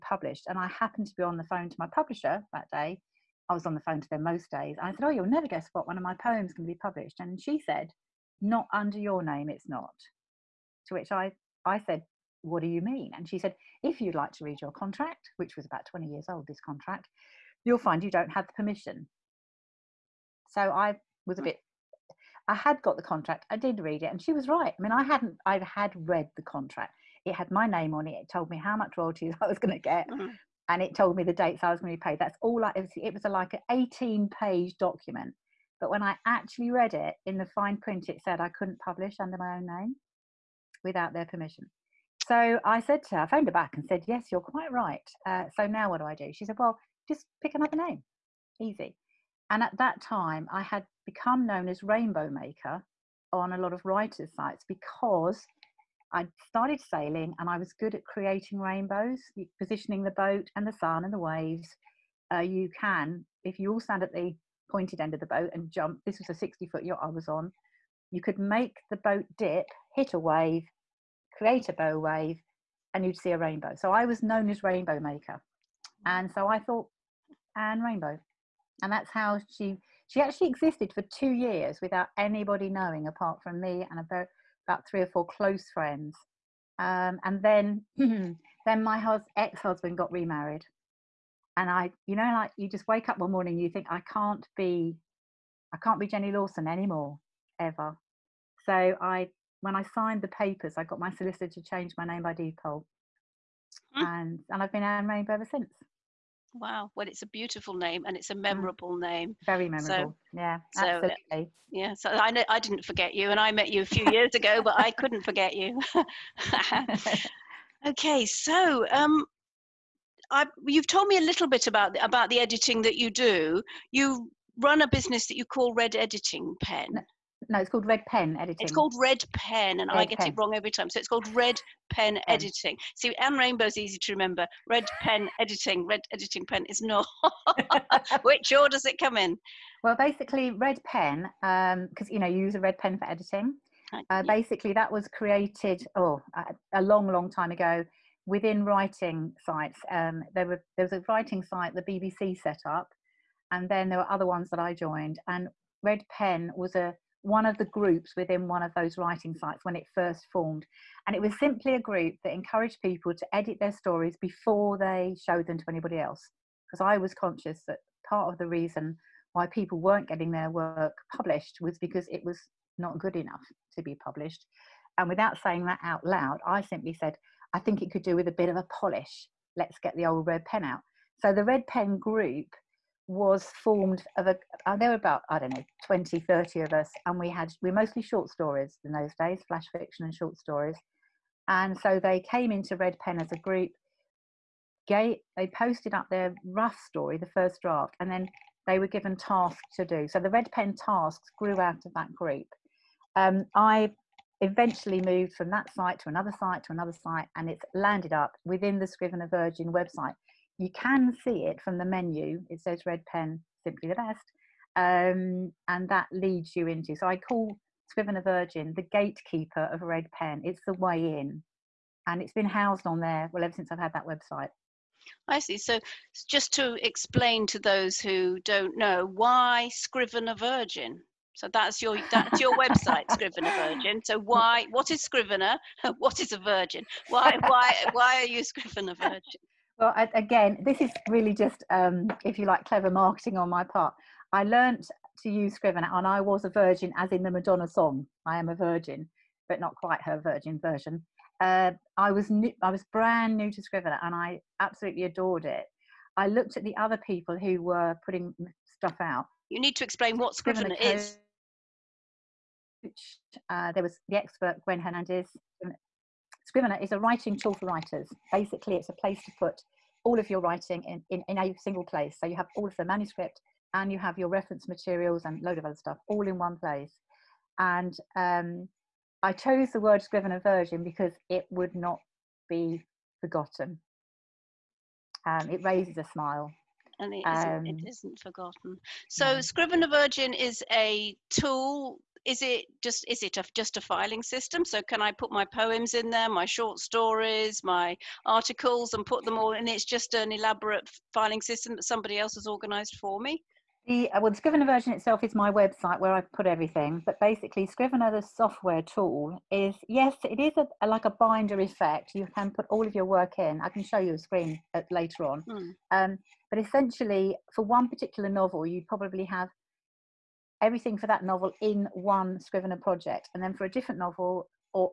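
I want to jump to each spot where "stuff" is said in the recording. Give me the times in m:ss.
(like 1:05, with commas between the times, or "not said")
4:18, 4:35.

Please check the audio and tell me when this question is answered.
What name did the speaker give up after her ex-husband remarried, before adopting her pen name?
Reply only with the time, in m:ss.
1:36.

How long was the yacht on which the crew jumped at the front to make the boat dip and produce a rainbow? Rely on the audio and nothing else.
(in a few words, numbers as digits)
60 foot.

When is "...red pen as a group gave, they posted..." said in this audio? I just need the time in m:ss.
3:12.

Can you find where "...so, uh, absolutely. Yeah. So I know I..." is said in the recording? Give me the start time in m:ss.
1:50.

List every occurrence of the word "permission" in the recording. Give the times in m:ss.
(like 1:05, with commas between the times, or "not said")
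0:18, 0:41.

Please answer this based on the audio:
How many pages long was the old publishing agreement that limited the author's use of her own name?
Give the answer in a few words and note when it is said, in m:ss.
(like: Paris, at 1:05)
18, at 0:33.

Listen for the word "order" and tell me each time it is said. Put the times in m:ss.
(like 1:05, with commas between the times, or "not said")
2:18.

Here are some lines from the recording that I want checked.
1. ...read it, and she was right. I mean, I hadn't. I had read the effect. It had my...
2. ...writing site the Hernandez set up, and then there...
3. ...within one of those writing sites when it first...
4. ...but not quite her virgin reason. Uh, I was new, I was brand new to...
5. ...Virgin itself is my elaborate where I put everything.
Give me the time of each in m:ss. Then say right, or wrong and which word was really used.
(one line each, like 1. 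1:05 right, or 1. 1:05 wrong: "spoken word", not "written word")
1. 0:23 wrong: "contract", not "effect"
2. 2:31 wrong: "BBC", not "Hernandez"
3. 2:38 right
4. 4:09 wrong: "version", not "reason"
5. 5:04 wrong: "website", not "elaborate".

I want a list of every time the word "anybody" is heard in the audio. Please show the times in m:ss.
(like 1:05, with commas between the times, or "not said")
1:22, 2:45.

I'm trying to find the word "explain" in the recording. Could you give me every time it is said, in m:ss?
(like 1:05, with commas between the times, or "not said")
3:46, 4:19.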